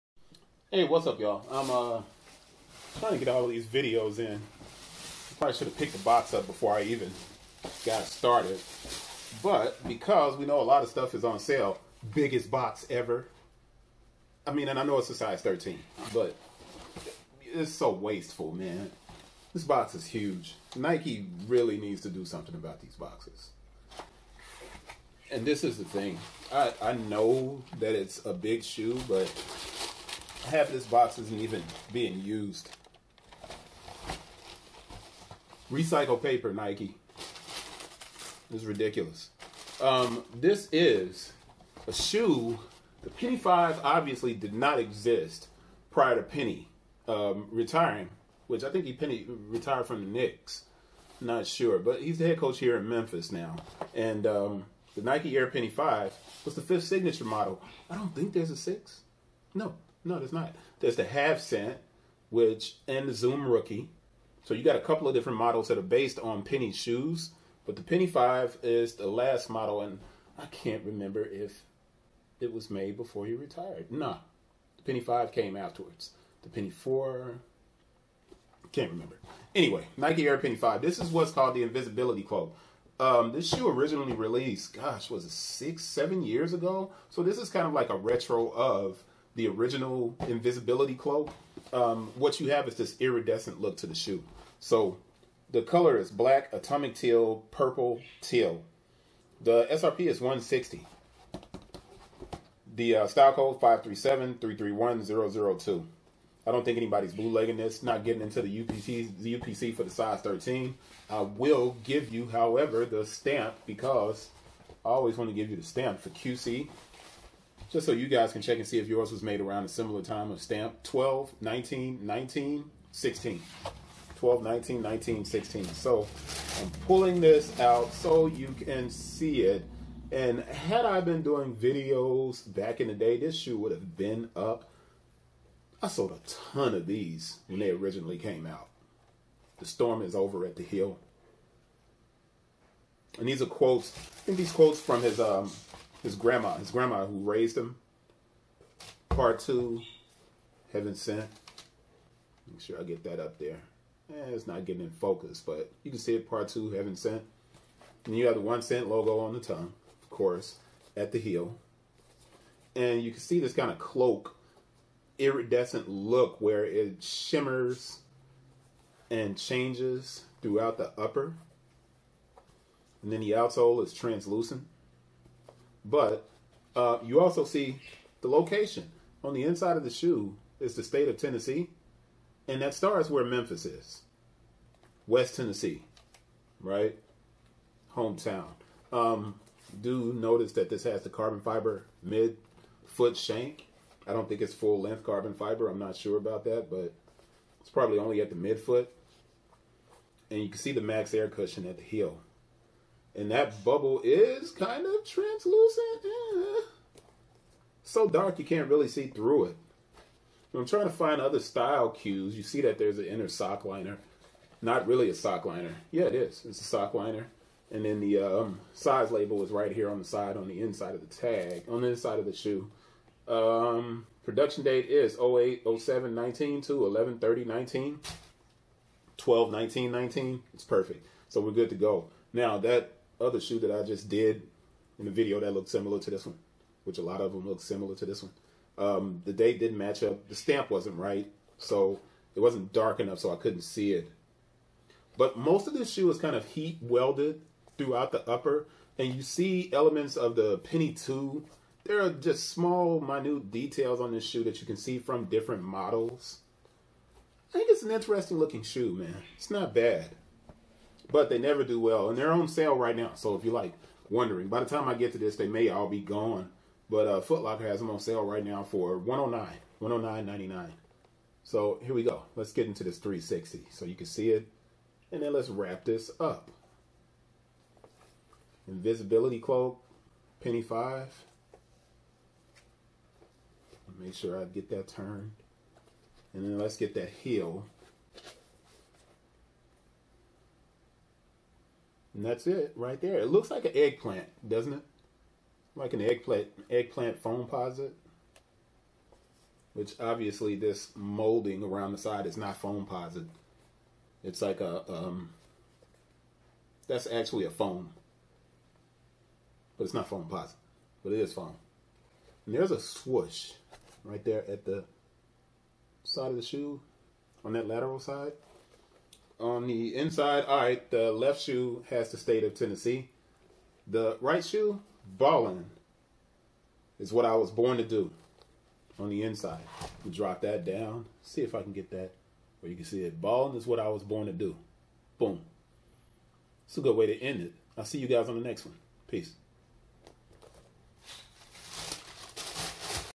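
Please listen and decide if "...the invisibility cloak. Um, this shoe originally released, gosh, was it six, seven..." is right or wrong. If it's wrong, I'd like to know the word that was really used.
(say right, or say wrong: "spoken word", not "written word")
right.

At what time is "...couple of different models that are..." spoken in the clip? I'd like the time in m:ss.
1:04.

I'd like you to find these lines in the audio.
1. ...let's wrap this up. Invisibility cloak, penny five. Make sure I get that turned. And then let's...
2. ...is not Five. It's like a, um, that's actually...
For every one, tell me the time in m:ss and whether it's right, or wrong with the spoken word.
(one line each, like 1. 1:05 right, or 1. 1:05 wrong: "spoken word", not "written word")
1. 4:35 right
2. 5:02 wrong: "Foamposite", not "Five".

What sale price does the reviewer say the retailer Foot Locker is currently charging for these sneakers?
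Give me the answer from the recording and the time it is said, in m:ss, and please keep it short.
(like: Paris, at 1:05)
$109.99, at 4:28.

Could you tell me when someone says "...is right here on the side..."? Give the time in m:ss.
3:39.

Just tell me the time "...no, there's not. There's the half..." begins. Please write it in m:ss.
1:00.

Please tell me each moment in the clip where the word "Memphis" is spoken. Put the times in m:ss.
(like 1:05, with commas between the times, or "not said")
0:52, 3:03.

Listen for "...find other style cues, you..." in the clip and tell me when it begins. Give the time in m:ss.
3:30.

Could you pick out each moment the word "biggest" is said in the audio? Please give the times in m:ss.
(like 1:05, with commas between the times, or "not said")
0:12.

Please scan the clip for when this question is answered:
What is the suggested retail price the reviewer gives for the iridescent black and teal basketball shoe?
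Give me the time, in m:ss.
1:39.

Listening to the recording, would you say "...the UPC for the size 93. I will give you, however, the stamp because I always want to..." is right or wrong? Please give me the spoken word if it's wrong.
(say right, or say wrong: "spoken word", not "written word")
wrong: "13", not "93".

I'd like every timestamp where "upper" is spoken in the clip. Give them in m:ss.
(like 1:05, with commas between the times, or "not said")
2:50, 4:08.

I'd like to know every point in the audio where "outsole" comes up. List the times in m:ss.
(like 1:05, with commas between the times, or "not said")
2:53.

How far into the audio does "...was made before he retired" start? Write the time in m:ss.
1:12.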